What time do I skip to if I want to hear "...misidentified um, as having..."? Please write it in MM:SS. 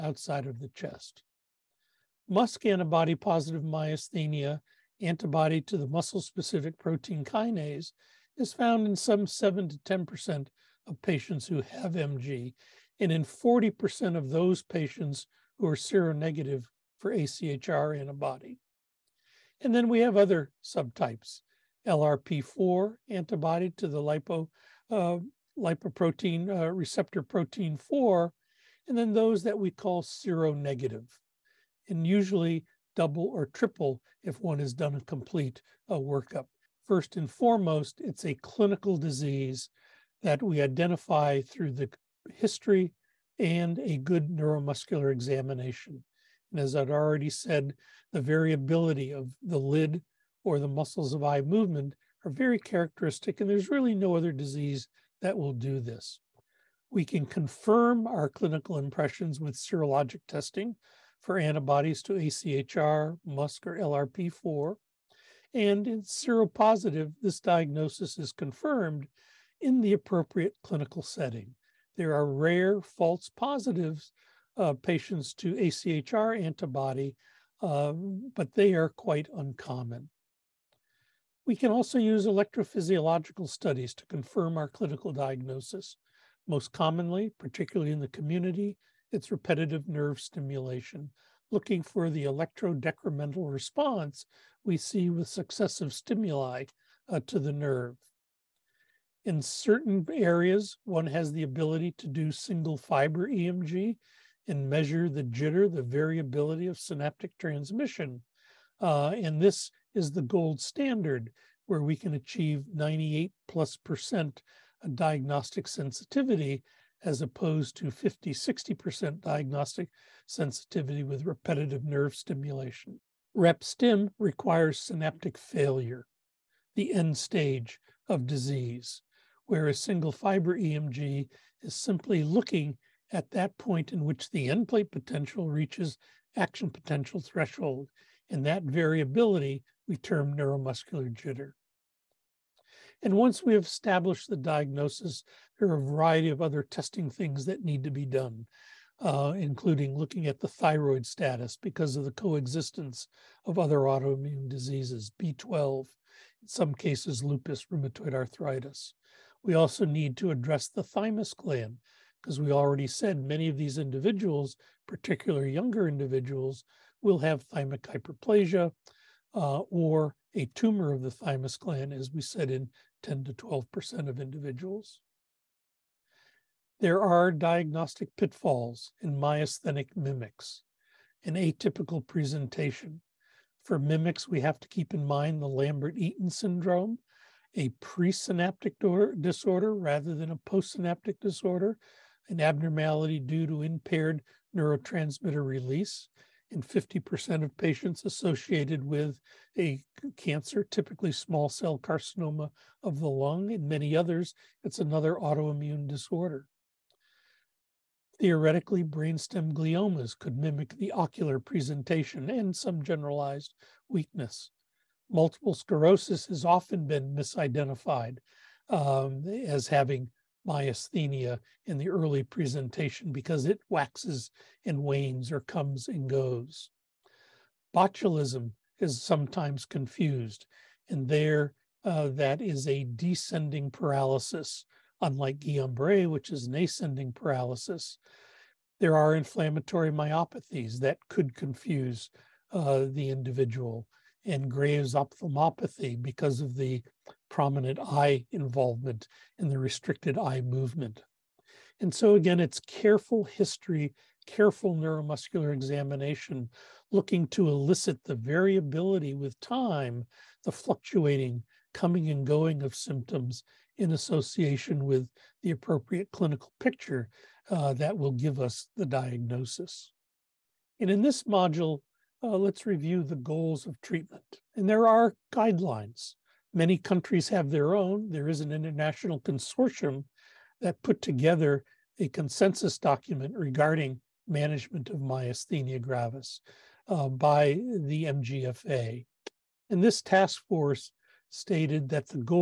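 03:37.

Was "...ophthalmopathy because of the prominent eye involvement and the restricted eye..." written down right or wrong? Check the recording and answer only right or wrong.
right.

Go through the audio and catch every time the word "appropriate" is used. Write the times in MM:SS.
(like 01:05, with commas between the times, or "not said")
01:09, 04:25.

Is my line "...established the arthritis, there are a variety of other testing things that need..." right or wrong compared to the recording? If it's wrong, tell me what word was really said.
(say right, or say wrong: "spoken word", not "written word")
wrong: "diagnosis", not "arthritis".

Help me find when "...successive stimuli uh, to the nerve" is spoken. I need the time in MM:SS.
01:35.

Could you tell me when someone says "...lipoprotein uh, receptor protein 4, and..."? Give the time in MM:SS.
00:25.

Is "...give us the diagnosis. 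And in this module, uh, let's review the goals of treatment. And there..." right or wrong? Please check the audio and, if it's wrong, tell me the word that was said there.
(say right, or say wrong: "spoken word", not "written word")
right.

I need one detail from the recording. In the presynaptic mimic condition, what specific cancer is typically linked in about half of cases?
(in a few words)
small cell carcinoma of the lung.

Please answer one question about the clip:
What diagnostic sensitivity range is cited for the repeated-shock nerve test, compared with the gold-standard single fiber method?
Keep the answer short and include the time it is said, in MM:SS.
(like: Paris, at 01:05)
50-60%, at 01:57.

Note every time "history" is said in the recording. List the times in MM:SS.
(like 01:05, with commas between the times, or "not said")
00:42, 04:13.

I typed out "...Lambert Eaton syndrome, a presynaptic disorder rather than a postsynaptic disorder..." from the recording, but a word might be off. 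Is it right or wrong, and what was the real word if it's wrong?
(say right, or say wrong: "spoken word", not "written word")
right.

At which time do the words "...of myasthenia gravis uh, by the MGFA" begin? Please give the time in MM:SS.
04:44.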